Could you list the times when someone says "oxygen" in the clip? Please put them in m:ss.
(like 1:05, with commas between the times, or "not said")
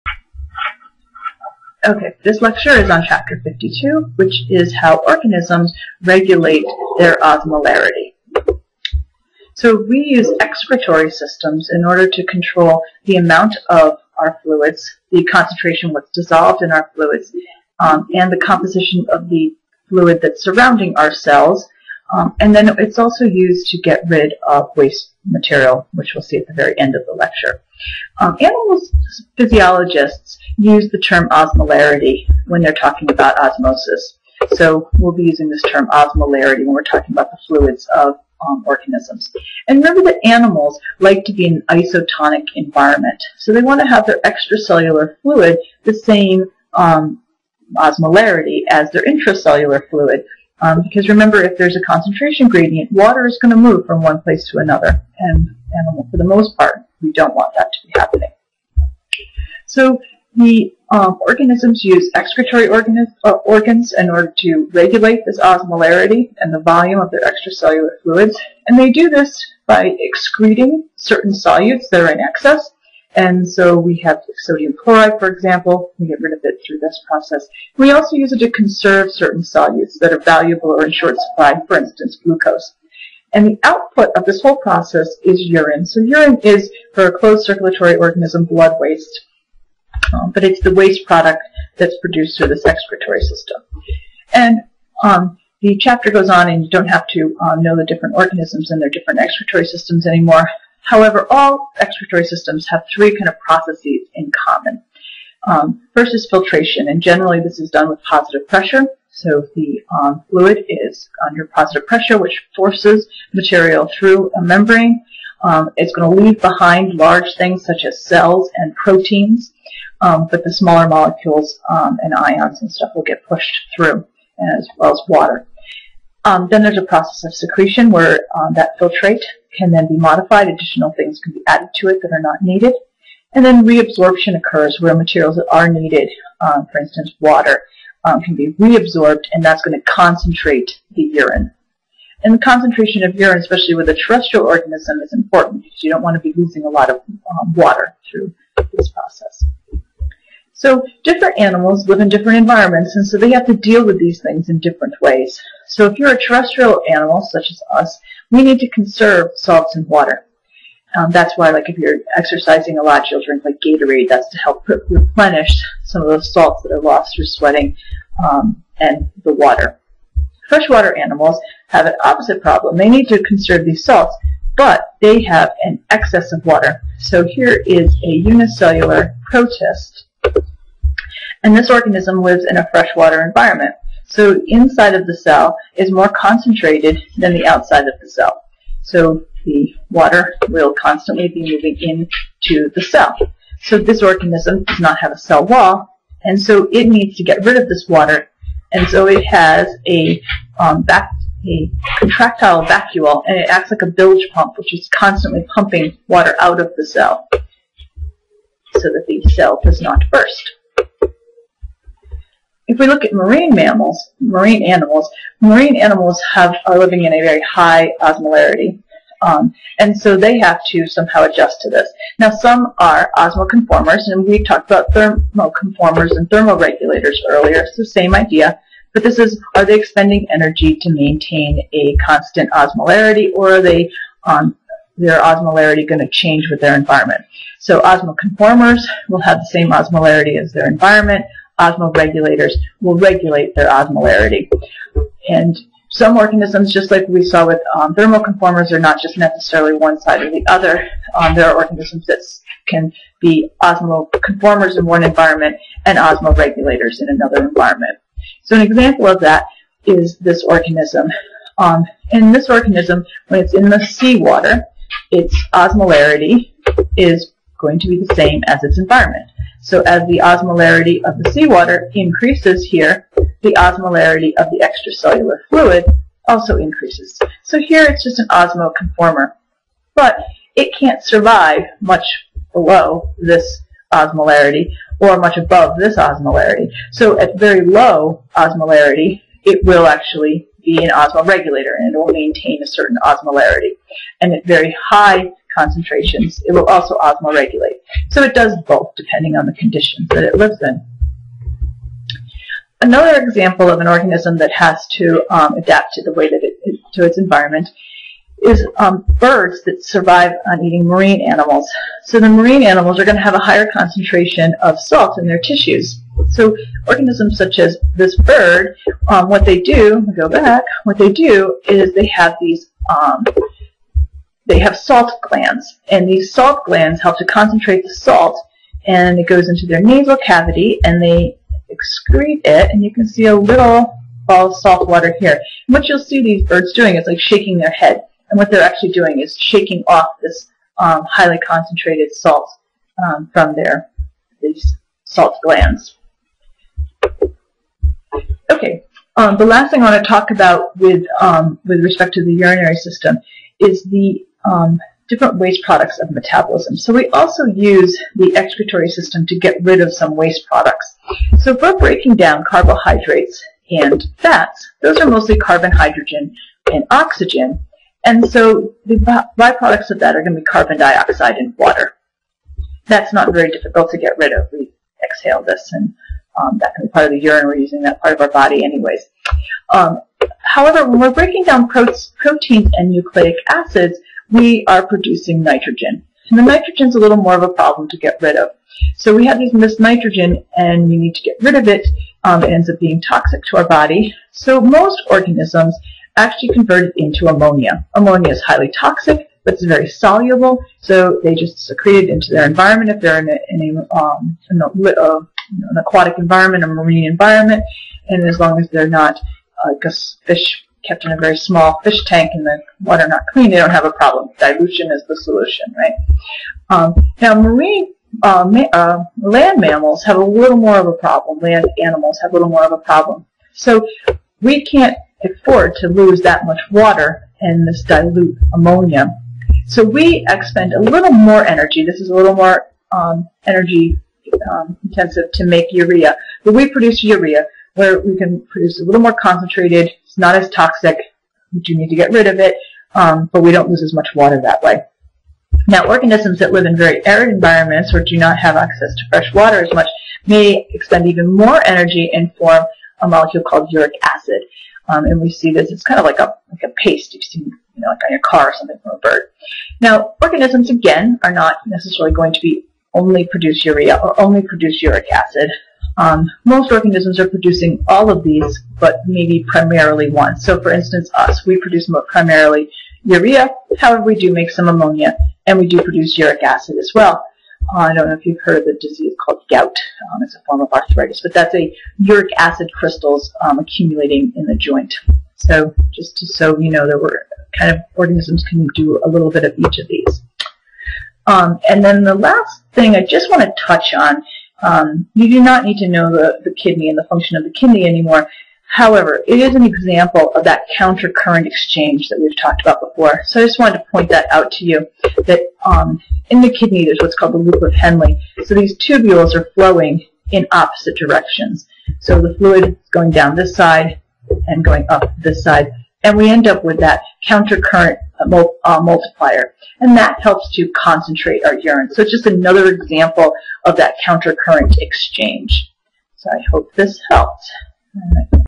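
6:06.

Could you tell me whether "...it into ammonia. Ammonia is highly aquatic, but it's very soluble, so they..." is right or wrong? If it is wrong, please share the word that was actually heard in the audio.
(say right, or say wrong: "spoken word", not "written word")
wrong: "toxic", not "aquatic".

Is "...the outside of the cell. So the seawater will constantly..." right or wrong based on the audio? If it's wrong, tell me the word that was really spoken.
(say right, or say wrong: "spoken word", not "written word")
wrong: "water", not "seawater".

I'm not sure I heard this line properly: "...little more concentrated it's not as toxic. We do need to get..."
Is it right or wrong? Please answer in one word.
right.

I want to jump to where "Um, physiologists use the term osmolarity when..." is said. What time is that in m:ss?
0:28.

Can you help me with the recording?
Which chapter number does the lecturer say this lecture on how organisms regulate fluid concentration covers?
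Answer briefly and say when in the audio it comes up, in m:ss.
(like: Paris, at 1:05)
52, at 0:03.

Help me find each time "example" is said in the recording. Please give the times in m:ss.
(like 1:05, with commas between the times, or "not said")
1:15, 4:18, 5:03, 8:19, 8:42.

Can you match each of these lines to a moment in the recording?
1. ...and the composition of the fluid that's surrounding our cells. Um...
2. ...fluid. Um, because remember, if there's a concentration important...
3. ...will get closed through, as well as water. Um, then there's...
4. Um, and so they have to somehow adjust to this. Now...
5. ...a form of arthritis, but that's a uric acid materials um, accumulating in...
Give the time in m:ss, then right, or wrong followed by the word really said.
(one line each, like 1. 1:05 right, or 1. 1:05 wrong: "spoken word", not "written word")
1. 0:18 right
2. 0:49 wrong: "gradient", not "important"
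3. 2:02 wrong: "pushed", not "closed"
4. 3:39 right
5. 8:00 wrong: "crystals", not "materials".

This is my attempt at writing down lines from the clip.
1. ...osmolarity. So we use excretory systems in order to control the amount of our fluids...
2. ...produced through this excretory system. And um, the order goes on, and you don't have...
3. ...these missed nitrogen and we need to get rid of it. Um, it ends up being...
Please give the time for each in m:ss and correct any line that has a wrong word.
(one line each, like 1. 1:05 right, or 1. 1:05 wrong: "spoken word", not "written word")
1. 0:07 right
2. 1:32 wrong: "chapter", not "order"
3. 6:29 right.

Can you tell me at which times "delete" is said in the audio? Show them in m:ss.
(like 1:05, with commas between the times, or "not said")
not said.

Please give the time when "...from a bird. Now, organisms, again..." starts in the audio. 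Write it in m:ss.
7:38.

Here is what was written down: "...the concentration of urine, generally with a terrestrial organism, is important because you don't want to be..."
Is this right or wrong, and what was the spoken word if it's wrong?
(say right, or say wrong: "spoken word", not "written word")
wrong: "especially", not "generally".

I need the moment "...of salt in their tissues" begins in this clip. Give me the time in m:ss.
5:14.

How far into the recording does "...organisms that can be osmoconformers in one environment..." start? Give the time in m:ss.
4:11.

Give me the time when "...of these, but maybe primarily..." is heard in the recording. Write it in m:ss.
7:48.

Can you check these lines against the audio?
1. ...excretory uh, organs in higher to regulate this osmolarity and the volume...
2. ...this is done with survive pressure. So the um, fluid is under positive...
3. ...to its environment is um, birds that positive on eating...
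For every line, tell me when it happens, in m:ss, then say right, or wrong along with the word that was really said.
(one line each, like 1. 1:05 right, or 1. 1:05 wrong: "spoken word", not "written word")
1. 1:02 wrong: "order", not "higher"
2. 1:47 wrong: "positive", not "survive"
3. 5:06 wrong: "survive", not "positive".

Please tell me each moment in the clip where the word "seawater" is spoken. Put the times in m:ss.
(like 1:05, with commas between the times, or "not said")
4:23, 4:31.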